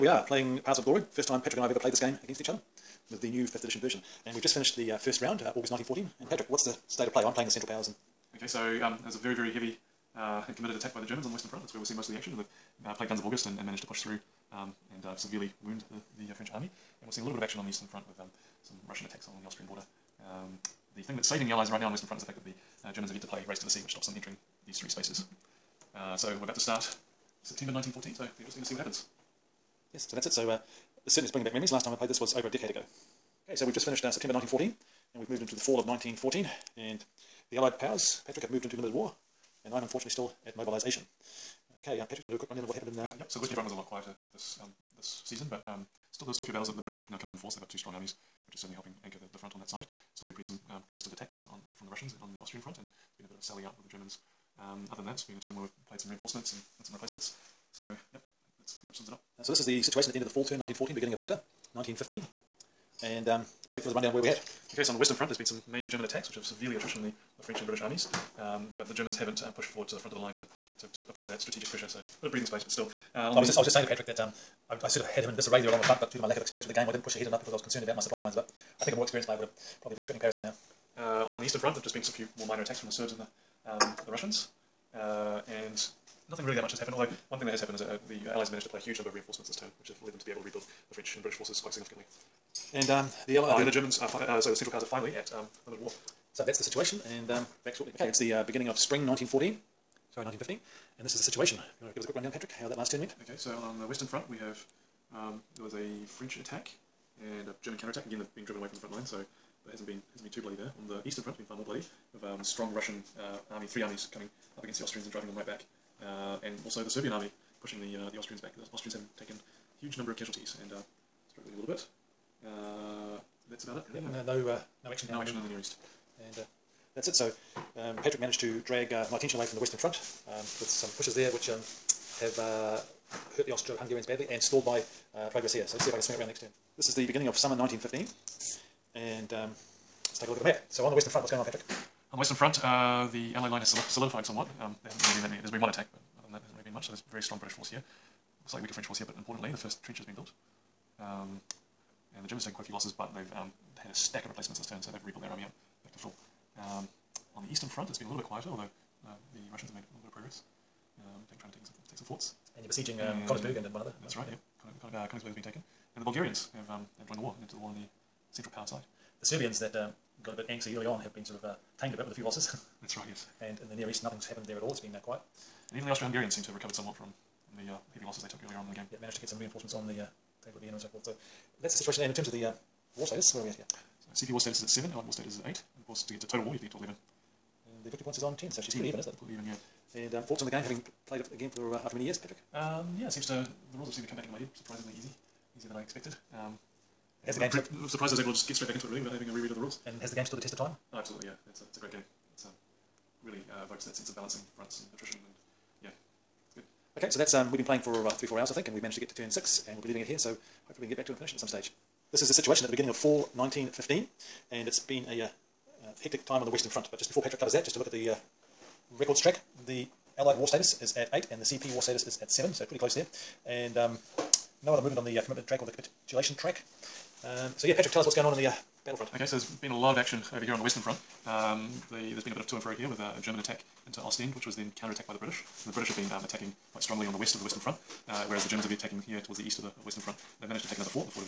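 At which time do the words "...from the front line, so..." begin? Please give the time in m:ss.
1:48.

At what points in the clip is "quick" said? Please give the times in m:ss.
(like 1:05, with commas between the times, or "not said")
0:42, 1:42.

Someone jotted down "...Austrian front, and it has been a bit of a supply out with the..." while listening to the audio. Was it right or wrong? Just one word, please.
wrong.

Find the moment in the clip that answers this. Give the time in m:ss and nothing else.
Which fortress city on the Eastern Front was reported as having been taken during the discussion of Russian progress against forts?
2:45.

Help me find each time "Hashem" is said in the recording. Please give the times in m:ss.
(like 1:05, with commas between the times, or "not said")
not said.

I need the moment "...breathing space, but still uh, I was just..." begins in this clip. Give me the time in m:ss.
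1:12.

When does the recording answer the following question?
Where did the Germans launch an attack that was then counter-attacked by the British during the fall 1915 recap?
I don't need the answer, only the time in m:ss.
3:53.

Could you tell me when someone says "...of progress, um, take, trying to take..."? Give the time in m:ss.
2:40.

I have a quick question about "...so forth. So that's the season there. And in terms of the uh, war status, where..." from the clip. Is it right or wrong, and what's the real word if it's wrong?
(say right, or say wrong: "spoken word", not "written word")
wrong: "situation", not "season".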